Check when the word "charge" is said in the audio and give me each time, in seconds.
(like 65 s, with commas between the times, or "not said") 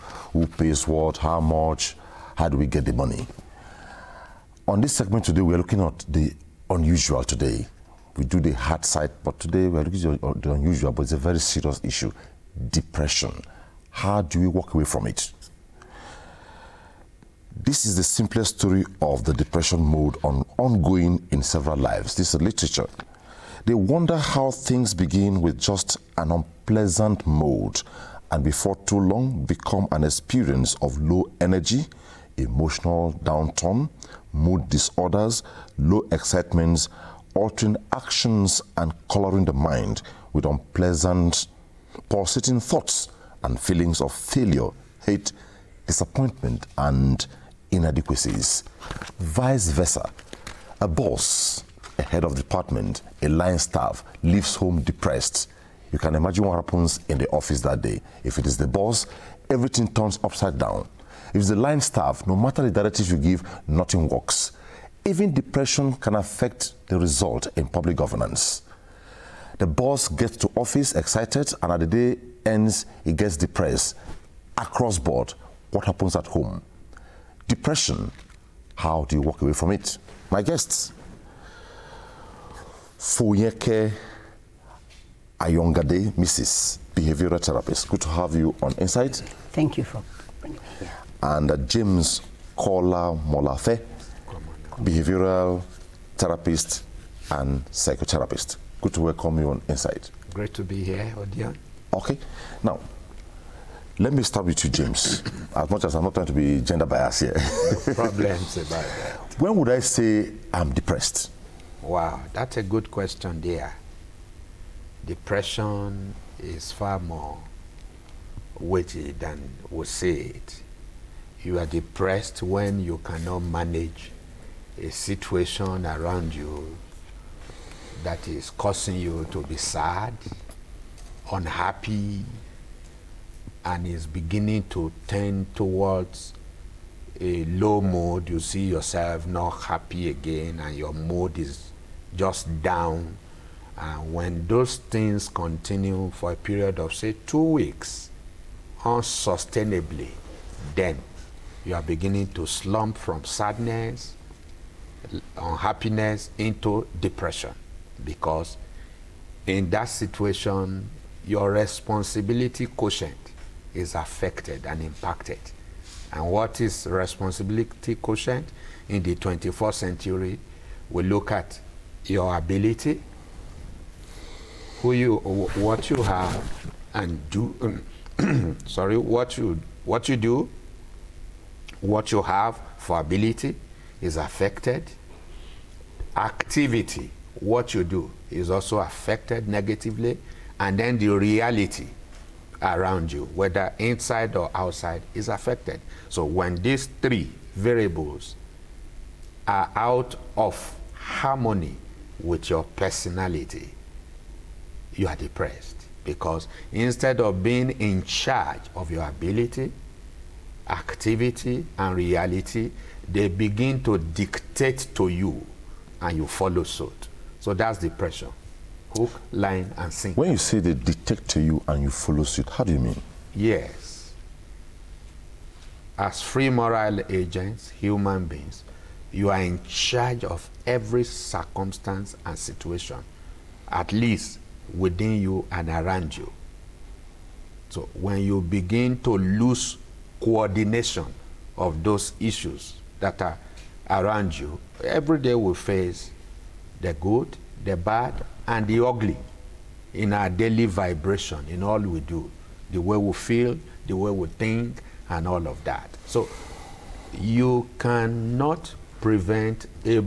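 208 s, 229 s.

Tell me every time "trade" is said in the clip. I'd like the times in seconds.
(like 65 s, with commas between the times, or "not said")
not said.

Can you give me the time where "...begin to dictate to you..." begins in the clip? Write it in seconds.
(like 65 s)
213 s.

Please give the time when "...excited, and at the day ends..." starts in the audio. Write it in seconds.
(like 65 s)
70 s.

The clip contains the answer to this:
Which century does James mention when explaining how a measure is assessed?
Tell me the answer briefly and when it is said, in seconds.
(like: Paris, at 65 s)
21st century, at 169 s.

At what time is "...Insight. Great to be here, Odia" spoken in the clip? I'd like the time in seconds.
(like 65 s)
99 s.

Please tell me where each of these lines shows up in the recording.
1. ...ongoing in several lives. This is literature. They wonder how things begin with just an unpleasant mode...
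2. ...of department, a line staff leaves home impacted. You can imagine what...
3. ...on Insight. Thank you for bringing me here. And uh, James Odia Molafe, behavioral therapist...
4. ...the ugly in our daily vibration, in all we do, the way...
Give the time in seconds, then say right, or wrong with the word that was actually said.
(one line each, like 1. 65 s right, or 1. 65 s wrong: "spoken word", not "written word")
1. 20 s right
2. 52 s wrong: "depressed", not "impacted"
3. 88 s wrong: "Kola", not "Odia"
4. 248 s right.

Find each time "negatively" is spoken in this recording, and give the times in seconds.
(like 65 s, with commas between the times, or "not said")
189 s.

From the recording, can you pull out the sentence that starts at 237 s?
So when you begin to lose coordination of those issues, that are around you.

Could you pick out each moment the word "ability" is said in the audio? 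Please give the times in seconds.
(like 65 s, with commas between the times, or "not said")
172 s, 182 s, 209 s.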